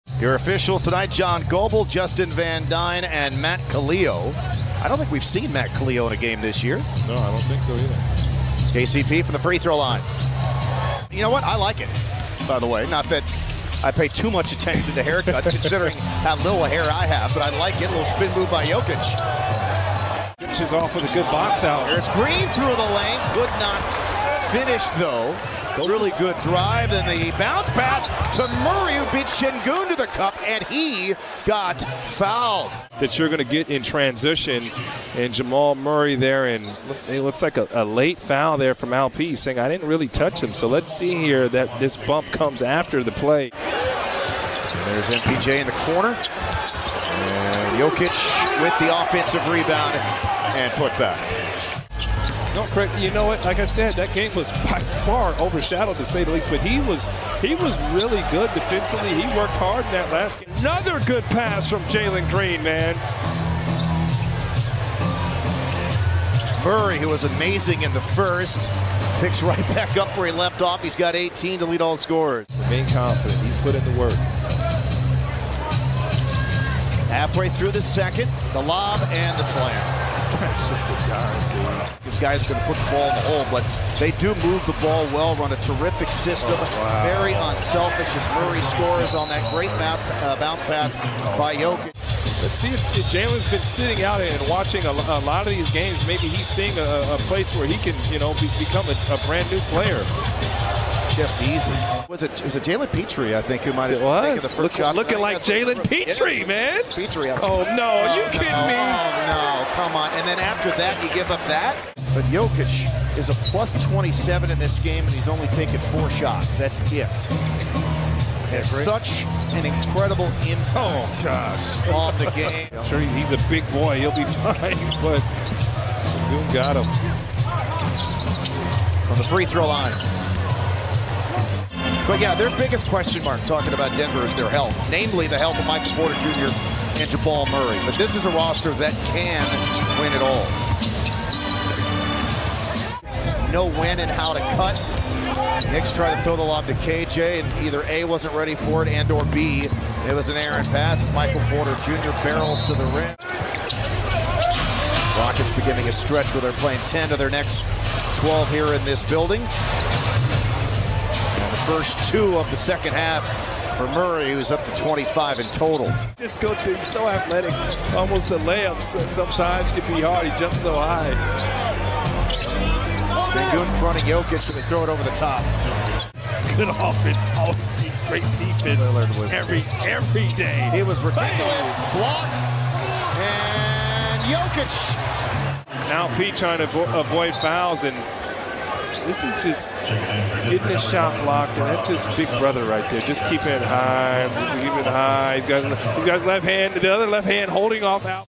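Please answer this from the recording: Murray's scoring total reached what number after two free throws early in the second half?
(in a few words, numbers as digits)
25.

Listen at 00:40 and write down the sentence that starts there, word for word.
So let's see here that this bump comes after the play.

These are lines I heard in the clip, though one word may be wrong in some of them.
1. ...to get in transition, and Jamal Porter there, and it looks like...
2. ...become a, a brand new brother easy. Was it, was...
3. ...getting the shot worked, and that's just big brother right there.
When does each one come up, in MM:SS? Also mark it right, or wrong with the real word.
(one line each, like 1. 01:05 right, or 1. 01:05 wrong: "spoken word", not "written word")
1. 00:33 wrong: "Murray", not "Porter"
2. 01:38 wrong: "player", not "brother"
3. 03:10 wrong: "blocked", not "worked".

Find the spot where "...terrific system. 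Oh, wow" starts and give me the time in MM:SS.
01:25.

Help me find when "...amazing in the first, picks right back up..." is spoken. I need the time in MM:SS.
01:07.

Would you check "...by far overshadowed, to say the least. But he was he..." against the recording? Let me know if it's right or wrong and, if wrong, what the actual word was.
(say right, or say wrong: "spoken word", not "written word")
right.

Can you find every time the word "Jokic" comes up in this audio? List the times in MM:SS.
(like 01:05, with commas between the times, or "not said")
00:18, 00:47, 01:31, 01:52, 02:54, 03:04.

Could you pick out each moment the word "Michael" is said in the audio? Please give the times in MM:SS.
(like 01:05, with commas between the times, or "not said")
02:15, 02:31.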